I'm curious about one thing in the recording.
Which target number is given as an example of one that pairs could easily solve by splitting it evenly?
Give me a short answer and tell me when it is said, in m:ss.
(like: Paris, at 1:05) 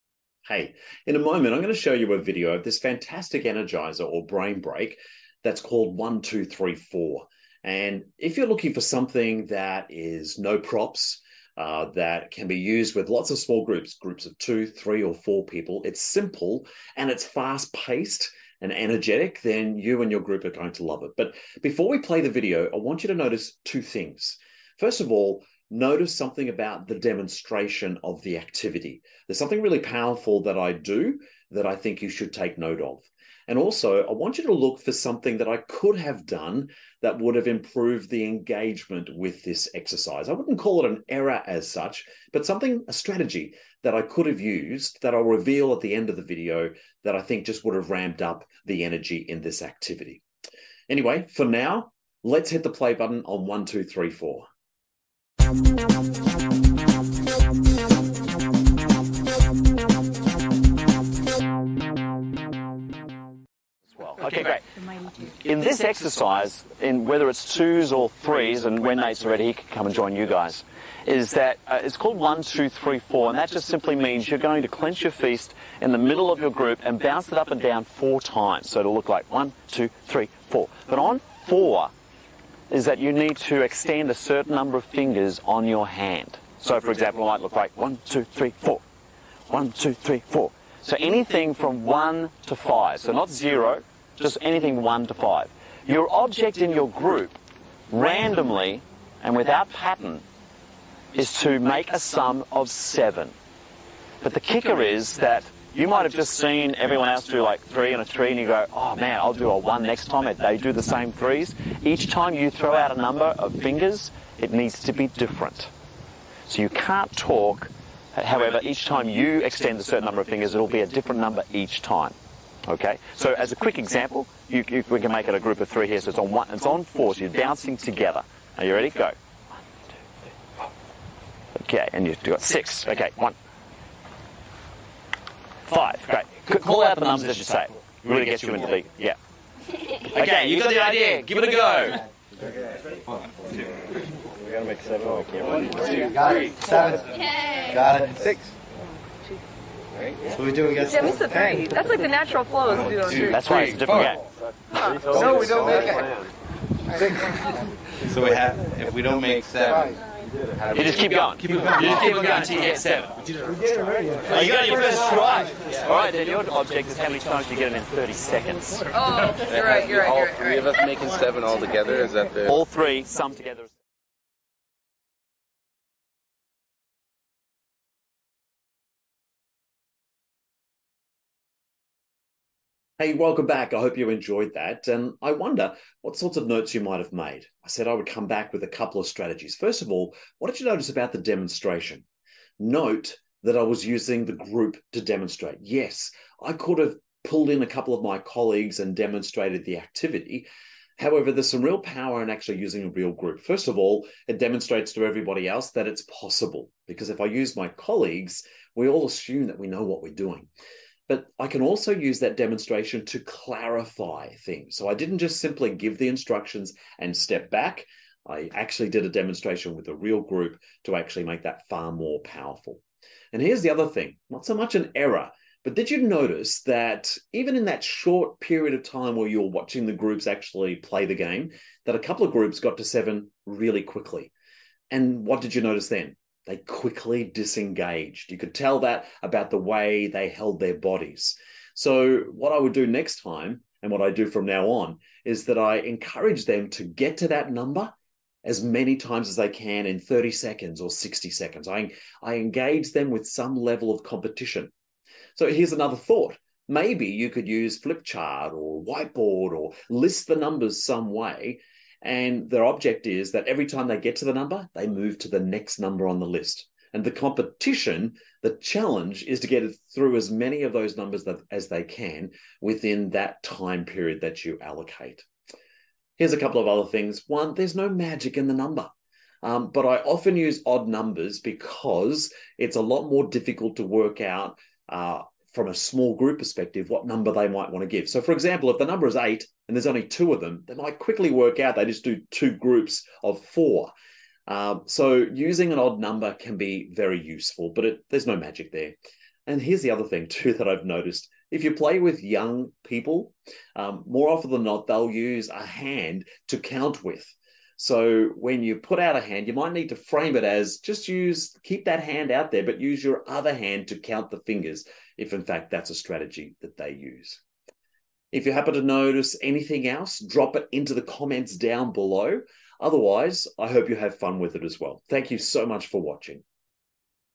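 8, at 4:49.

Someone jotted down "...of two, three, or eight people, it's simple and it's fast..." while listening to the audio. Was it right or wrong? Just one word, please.
wrong.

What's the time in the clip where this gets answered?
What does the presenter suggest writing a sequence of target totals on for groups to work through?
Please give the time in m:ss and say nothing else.
4:17.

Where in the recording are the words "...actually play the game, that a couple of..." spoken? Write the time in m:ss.
3:50.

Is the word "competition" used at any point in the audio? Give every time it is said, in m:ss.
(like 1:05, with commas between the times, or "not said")
4:14, 4:27.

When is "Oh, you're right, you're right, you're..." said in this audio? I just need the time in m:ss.
2:48.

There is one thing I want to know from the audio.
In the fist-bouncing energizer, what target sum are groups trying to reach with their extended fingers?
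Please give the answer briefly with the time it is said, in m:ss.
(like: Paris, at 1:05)
7, at 1:41.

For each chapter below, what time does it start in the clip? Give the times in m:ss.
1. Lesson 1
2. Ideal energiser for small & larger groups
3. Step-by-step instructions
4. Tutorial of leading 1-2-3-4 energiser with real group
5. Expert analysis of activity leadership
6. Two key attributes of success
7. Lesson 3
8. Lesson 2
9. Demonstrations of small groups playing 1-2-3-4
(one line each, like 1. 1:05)
1. 3:15
2. 0:10
3. 1:15
4. 0:55
5. 3:00
6. 0:25
7. 4:35
8. 4:10
9. 2:25.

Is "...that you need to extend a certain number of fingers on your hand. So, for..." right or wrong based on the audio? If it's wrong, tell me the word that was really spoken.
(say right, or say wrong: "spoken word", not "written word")
right.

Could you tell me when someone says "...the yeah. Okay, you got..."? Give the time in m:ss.
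2:18.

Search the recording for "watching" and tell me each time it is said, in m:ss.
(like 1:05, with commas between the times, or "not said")
3:49, 5:25.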